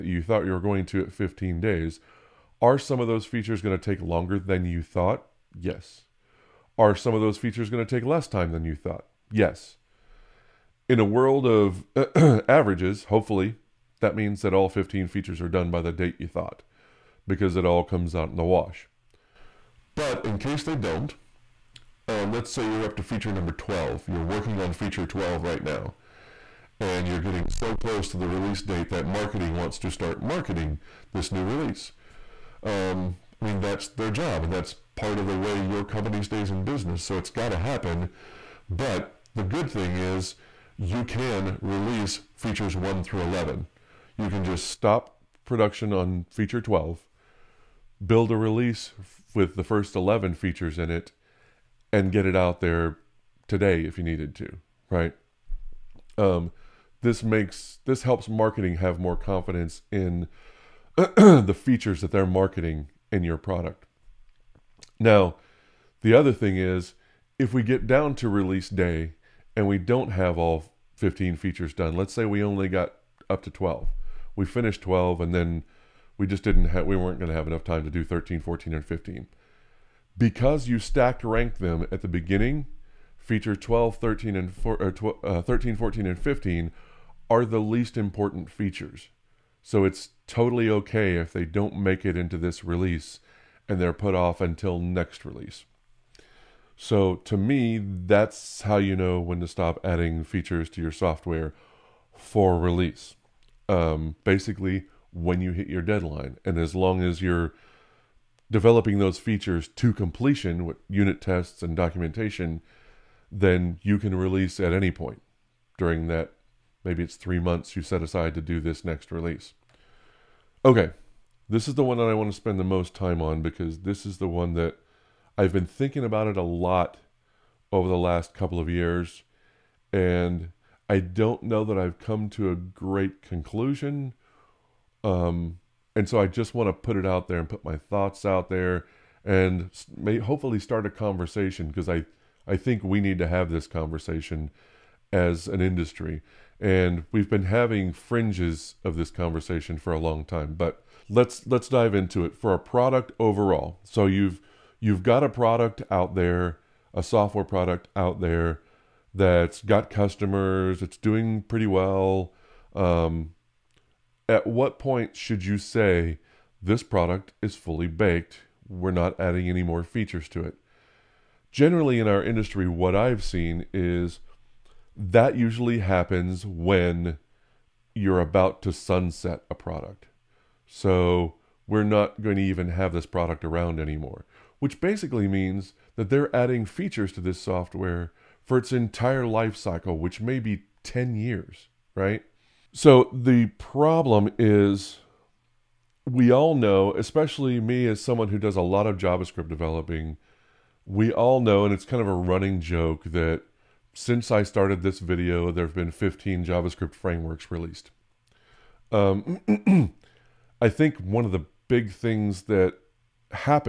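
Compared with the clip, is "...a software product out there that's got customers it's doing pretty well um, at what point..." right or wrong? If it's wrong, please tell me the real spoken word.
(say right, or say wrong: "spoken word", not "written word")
right.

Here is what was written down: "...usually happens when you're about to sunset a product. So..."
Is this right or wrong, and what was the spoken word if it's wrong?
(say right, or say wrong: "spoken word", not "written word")
right.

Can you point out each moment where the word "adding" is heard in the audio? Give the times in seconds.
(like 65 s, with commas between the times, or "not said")
99 s, 169 s, 186 s.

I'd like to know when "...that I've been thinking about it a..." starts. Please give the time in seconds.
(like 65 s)
124 s.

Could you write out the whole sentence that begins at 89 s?
So it's totally okay if they don't make it into this release and they're put off until next release.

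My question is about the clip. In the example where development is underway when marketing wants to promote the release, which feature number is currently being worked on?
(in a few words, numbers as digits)
12.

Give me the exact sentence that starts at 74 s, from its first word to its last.
We finished 12 and then we just didn't have we weren't going to have enough time to do 13, 14 and 15.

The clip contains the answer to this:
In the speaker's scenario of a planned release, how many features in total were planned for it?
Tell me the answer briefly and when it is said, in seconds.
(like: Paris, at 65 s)
15, at 1 s.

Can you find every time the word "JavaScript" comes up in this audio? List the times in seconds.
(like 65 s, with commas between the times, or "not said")
198 s, 206 s.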